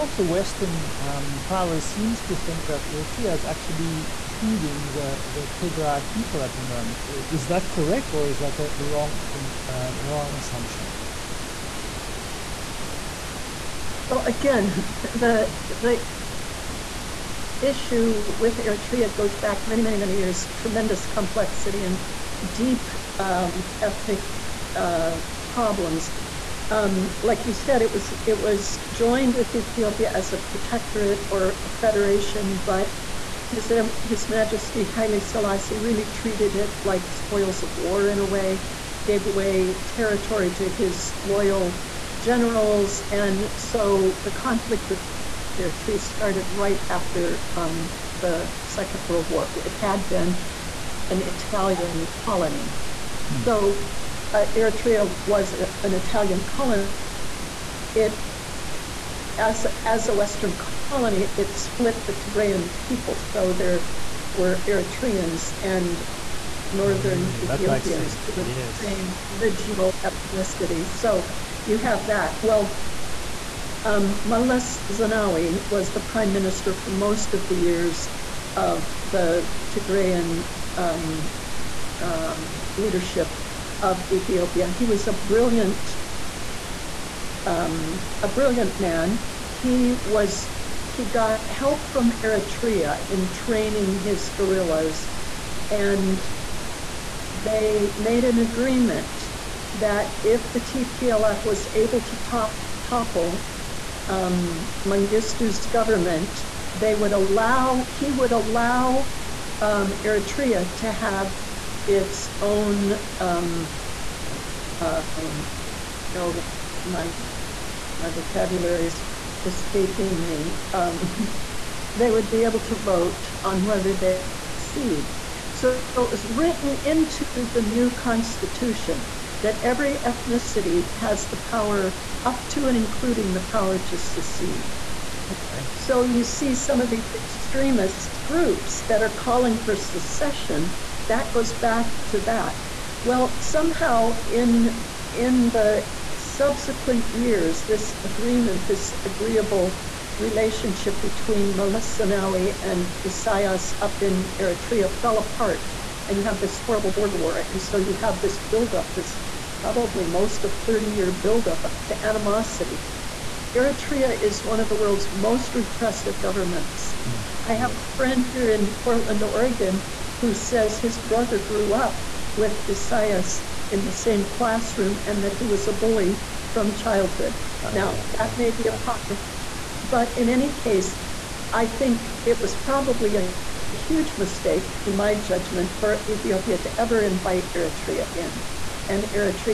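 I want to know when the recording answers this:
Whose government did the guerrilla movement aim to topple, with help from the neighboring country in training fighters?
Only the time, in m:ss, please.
1:44.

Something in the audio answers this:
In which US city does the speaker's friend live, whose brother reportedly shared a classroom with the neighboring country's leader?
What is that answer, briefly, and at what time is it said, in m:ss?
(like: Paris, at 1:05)
Portland, Oregon, at 2:48.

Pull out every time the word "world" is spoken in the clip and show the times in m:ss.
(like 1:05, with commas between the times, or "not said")
0:49, 2:44.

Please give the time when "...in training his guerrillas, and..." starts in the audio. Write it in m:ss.
1:33.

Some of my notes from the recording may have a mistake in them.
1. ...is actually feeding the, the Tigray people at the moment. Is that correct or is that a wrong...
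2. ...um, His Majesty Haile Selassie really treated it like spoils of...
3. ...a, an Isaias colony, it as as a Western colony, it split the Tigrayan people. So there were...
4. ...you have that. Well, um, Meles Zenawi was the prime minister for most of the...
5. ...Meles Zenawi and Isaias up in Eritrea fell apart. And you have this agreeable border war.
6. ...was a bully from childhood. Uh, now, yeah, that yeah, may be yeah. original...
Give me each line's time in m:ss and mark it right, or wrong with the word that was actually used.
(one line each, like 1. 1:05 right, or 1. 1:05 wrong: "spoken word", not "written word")
1. 0:03 right
2. 0:33 right
3. 0:55 wrong: "Italian", not "Isaias"
4. 1:11 right
5. 2:31 wrong: "horrible", not "agreeable"
6. 2:55 wrong: "apocryphal", not "original".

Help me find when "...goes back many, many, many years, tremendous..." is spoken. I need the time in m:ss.
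0:19.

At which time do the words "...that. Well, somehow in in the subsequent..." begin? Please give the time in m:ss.
2:22.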